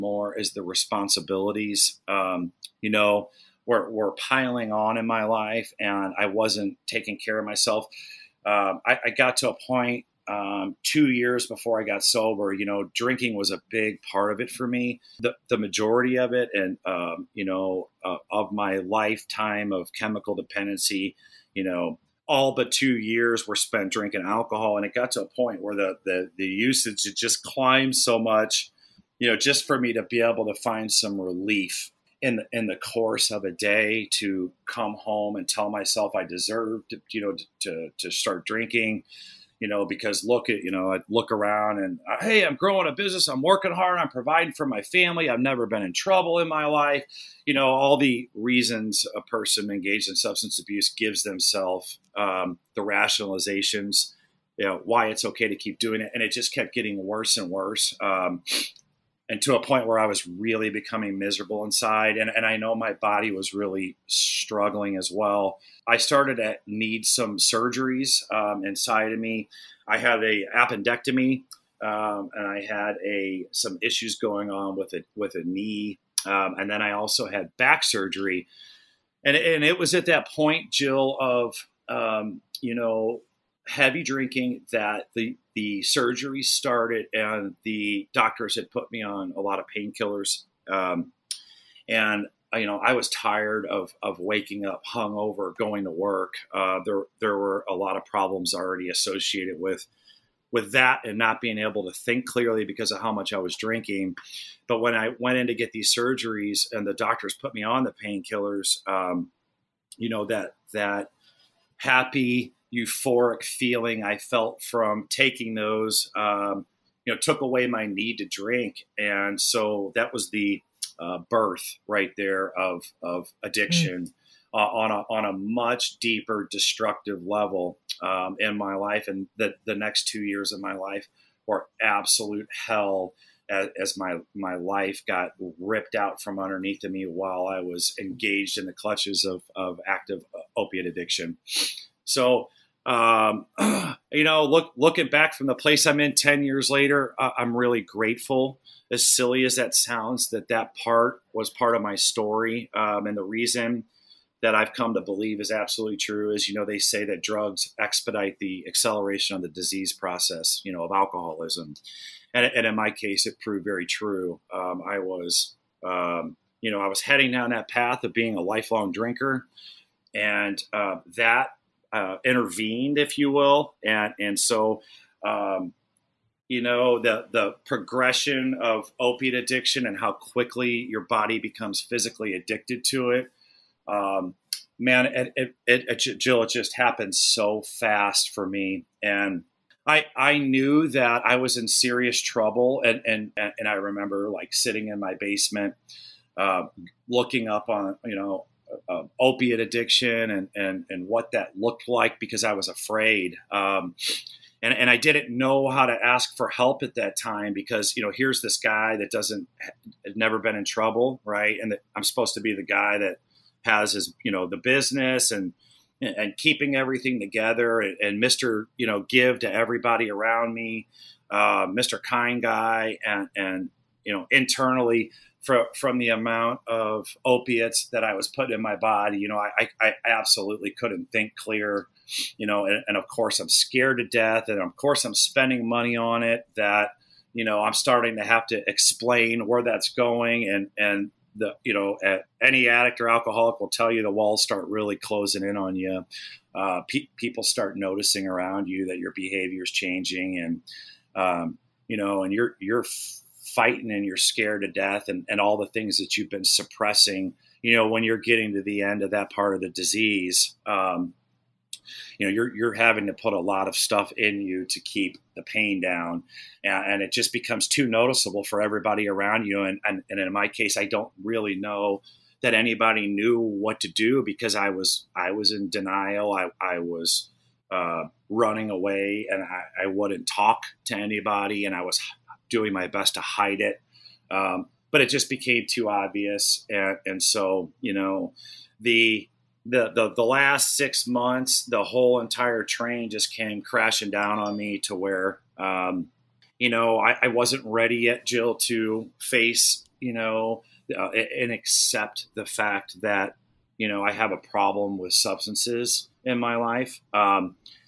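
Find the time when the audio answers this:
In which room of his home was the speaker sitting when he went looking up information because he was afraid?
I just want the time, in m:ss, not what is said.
3:15.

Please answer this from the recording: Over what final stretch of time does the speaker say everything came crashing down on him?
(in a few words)
Last 6 months.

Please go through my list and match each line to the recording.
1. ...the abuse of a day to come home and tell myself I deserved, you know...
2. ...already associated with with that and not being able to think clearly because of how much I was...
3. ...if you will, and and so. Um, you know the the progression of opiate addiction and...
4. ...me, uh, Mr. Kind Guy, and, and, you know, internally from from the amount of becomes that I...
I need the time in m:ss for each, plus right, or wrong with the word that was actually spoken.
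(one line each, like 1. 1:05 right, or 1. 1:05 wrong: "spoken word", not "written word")
1. 0:32 wrong: "course", not "abuse"
2. 1:38 right
3. 2:52 right
4. 3:40 wrong: "opiates", not "becomes".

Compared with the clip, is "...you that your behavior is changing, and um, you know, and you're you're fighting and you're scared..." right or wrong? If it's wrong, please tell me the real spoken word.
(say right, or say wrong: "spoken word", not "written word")
right.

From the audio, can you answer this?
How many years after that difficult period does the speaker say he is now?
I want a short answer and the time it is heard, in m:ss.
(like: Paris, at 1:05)
10 years, at 2:26.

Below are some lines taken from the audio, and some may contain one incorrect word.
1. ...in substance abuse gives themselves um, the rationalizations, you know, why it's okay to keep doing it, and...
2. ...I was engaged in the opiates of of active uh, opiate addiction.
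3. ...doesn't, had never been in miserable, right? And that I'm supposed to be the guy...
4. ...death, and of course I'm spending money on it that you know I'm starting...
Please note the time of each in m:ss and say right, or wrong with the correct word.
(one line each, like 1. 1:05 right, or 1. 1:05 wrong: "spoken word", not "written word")
1. 0:50 right
2. 2:17 wrong: "clutches", not "opiates"
3. 3:29 wrong: "trouble", not "miserable"
4. 3:54 right.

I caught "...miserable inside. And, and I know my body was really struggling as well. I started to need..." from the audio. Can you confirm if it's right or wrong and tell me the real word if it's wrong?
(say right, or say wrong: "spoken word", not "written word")
right.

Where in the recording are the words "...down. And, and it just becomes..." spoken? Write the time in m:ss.
4:25.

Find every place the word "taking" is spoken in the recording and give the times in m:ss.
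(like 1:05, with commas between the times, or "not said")
0:06, 1:55.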